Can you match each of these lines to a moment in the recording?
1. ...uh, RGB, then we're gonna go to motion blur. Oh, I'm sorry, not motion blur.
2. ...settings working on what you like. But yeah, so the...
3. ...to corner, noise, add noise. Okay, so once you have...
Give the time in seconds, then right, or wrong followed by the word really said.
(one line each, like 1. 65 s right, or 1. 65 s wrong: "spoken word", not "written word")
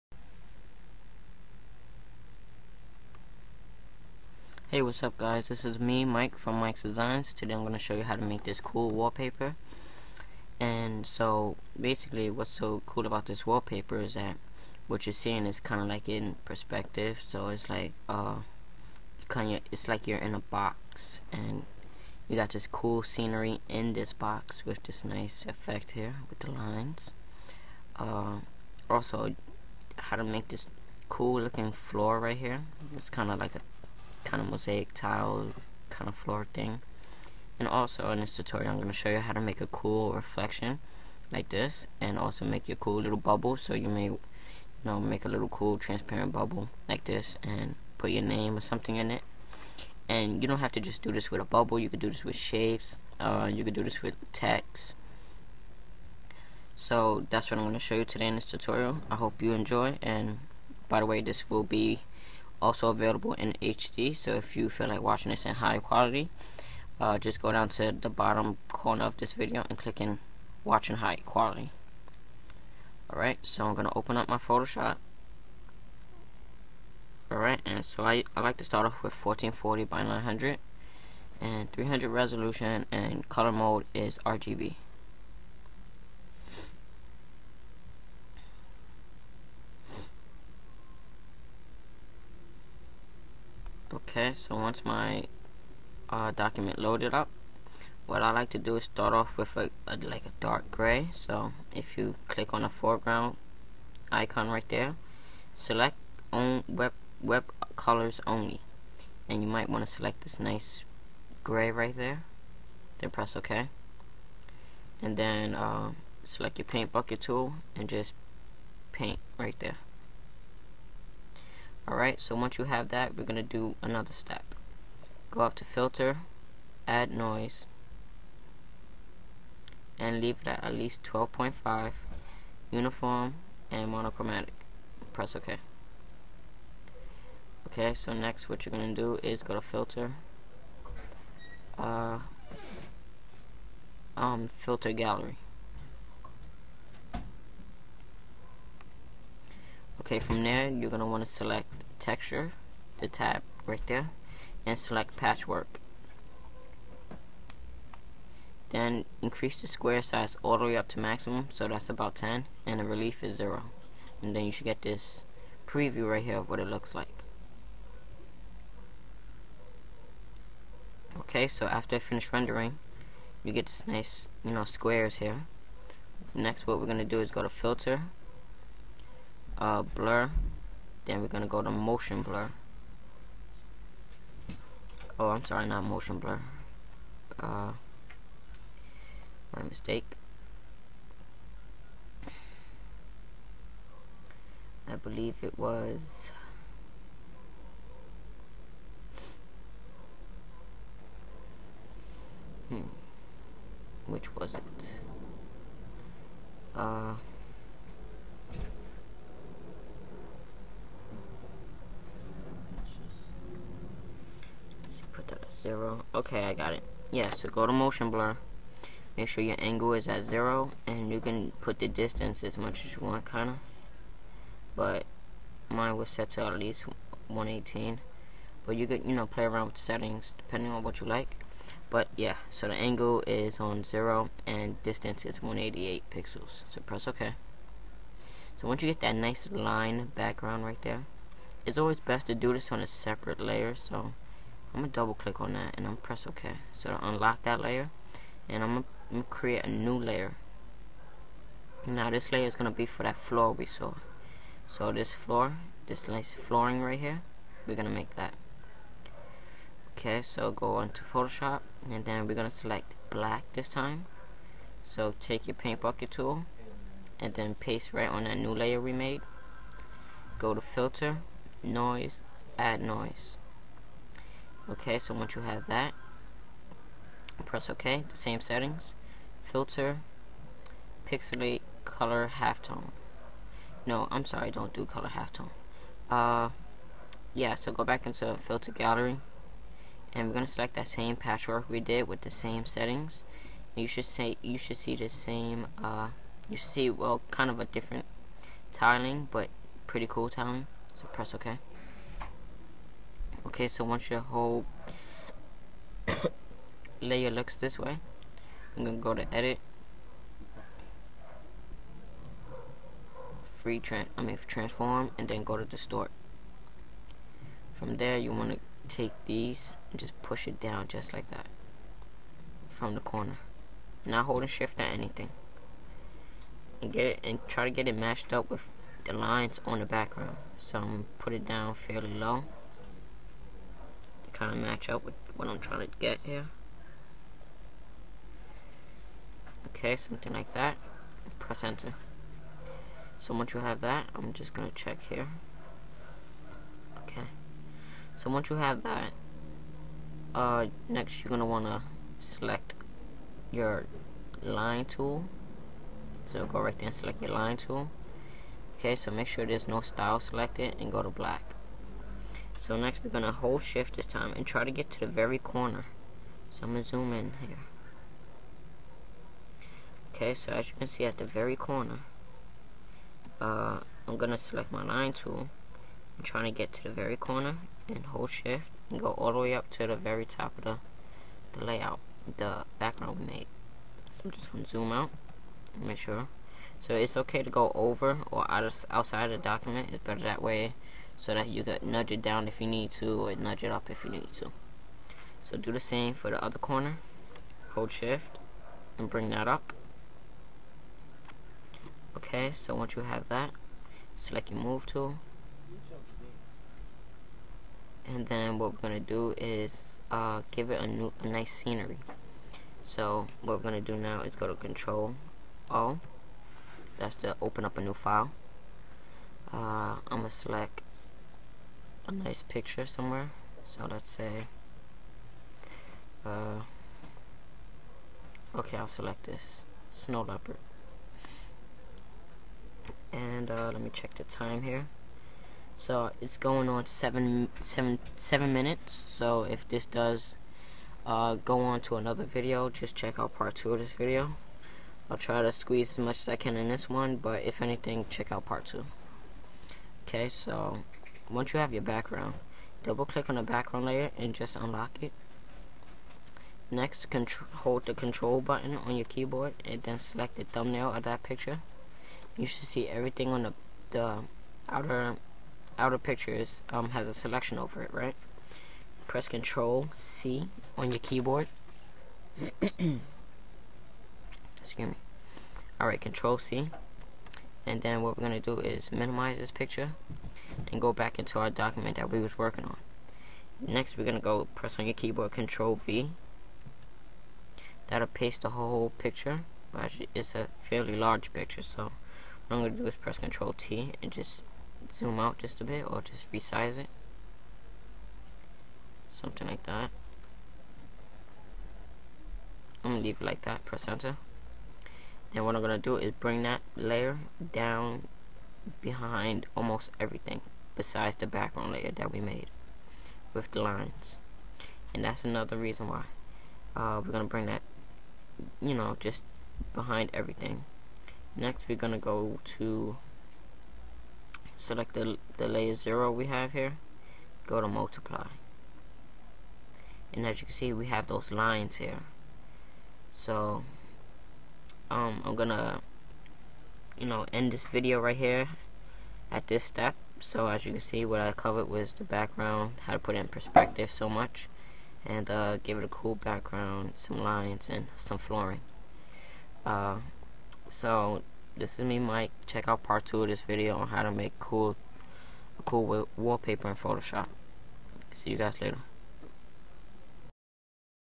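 1. 179 s wrong: "Blur", not "RGB"
2. 229 s wrong: "depending", not "working"
3. 270 s wrong: "filter", not "corner".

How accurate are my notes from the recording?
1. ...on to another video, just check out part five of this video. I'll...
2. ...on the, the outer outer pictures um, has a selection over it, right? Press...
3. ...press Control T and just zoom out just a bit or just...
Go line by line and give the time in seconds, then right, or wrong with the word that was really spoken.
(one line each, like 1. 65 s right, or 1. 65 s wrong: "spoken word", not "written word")
1. 441 s wrong: "two", not "five"
2. 463 s right
3. 492 s right.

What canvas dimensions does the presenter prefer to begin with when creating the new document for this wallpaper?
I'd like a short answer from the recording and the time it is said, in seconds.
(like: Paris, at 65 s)
1440 by 900, at 79 s.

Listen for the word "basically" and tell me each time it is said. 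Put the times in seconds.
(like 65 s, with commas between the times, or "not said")
11 s.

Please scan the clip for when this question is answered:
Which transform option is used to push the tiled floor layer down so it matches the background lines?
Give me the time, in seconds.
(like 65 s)
315 s.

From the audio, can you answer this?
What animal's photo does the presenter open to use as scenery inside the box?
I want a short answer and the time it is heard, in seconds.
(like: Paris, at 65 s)
snow leopard, at 429 s.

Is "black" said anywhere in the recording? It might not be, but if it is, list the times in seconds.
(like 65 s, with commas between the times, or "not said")
263 s, 361 s.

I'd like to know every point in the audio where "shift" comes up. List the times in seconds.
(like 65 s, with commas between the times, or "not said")
324 s, 363 s, 378 s, 397 s.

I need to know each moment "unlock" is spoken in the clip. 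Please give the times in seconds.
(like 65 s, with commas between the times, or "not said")
247 s, 454 s.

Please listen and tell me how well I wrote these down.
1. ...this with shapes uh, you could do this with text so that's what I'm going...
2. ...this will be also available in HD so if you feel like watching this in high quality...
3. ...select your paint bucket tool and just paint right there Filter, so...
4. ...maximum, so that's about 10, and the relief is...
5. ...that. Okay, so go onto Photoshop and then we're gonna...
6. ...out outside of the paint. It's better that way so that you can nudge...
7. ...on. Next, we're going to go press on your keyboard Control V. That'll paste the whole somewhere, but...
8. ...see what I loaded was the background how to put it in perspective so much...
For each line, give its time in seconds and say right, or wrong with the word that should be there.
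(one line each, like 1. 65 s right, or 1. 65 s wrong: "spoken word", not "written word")
1. 52 s right
2. 61 s right
3. 116 s wrong: "Alright", not "Filter"
4. 160 s right
5. 258 s right
6. 388 s wrong: "document", not "paint"
7. 482 s wrong: "picture", not "somewhere"
8. 540 s wrong: "covered", not "loaded".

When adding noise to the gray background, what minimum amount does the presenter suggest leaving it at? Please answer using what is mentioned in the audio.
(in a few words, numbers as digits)
12.5.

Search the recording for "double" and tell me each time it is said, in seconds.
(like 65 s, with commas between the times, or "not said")
244 s, 452 s.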